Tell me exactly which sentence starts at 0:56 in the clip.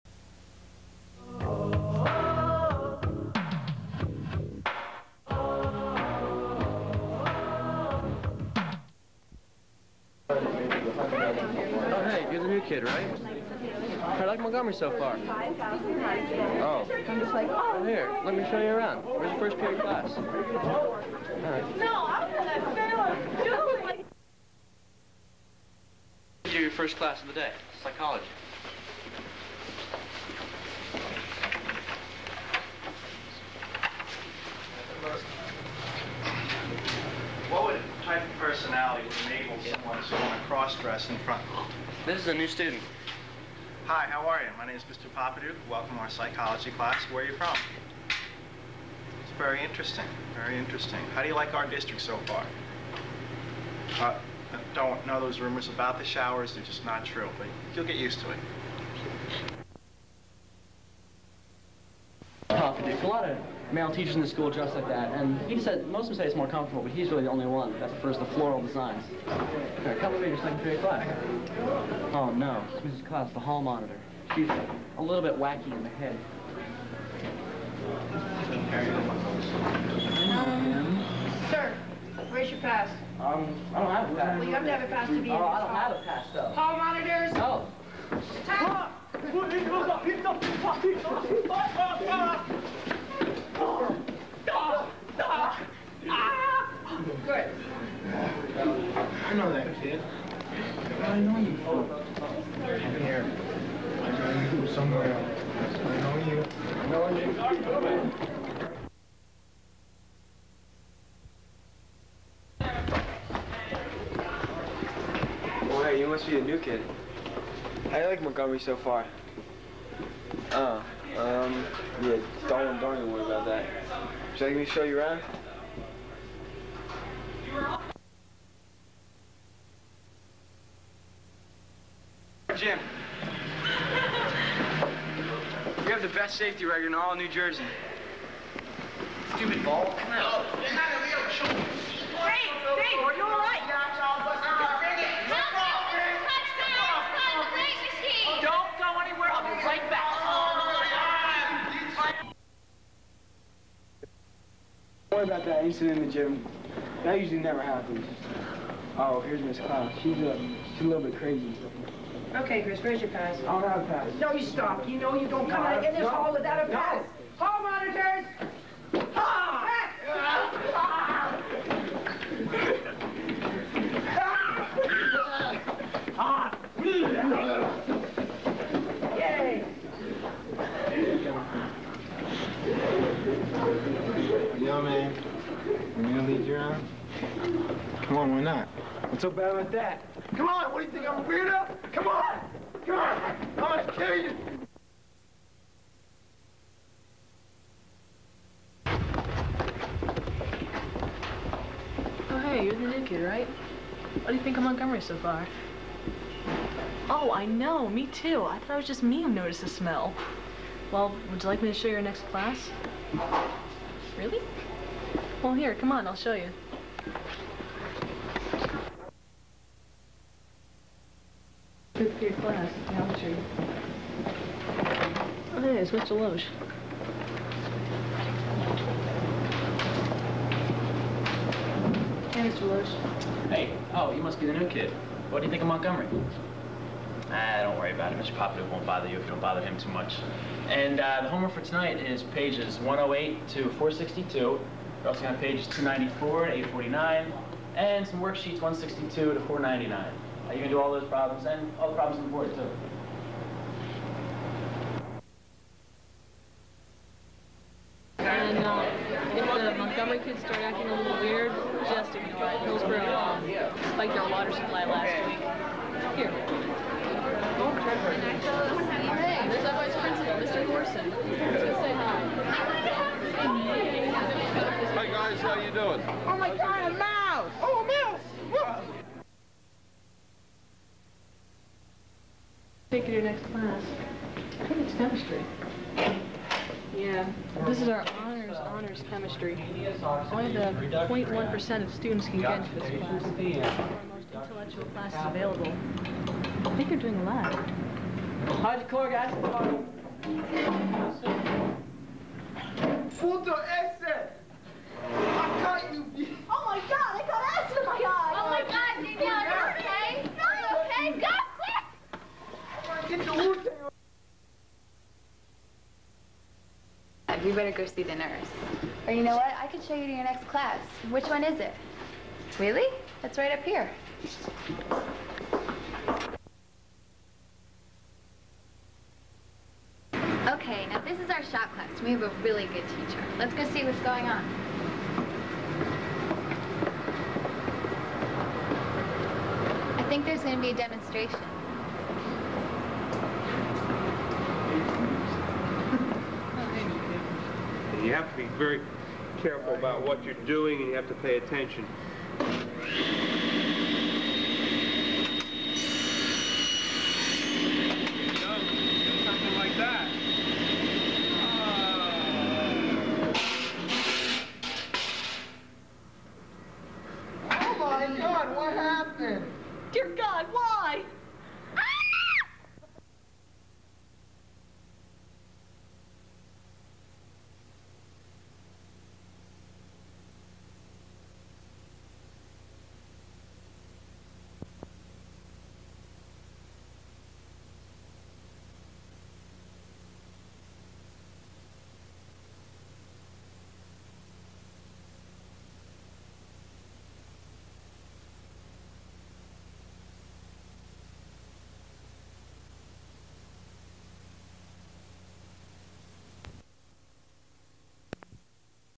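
They're just not true, but you'll get used to it.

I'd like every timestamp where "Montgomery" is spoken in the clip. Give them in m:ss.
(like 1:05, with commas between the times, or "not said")
0:14, 1:58, 3:24, 3:55, 4:19.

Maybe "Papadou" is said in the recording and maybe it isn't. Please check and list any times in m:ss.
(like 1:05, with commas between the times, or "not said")
0:45, 1:02.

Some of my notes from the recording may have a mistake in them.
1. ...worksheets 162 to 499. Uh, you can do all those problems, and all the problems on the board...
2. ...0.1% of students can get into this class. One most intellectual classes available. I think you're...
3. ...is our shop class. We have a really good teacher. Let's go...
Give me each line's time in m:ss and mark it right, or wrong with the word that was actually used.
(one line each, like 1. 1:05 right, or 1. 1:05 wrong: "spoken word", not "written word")
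1. 4:08 right
2. 4:51 right
3. 5:31 right.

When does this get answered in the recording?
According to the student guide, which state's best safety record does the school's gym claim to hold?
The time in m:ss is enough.
2:17.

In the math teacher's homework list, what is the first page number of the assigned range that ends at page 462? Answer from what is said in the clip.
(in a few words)
108.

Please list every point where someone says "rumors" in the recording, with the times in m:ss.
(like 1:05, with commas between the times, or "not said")
0:55.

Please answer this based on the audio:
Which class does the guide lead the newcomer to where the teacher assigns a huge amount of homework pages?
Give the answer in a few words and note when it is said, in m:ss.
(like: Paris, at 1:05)
Geometry, at 3:42.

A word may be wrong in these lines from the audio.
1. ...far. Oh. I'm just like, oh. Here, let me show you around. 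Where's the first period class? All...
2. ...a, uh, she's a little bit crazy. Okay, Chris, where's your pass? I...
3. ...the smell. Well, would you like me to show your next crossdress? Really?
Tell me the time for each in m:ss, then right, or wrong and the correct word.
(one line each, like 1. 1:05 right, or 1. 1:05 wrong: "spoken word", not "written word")
1. 0:14 right
2. 2:40 right
3. 3:29 wrong: "class", not "crossdress".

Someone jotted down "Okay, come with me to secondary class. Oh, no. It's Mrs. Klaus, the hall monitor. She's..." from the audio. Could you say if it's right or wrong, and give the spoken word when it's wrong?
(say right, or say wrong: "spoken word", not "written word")
right.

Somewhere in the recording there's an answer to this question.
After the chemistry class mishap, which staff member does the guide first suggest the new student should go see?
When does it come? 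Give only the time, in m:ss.
5:18.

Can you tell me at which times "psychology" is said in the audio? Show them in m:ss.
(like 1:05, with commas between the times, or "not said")
0:27, 0:46.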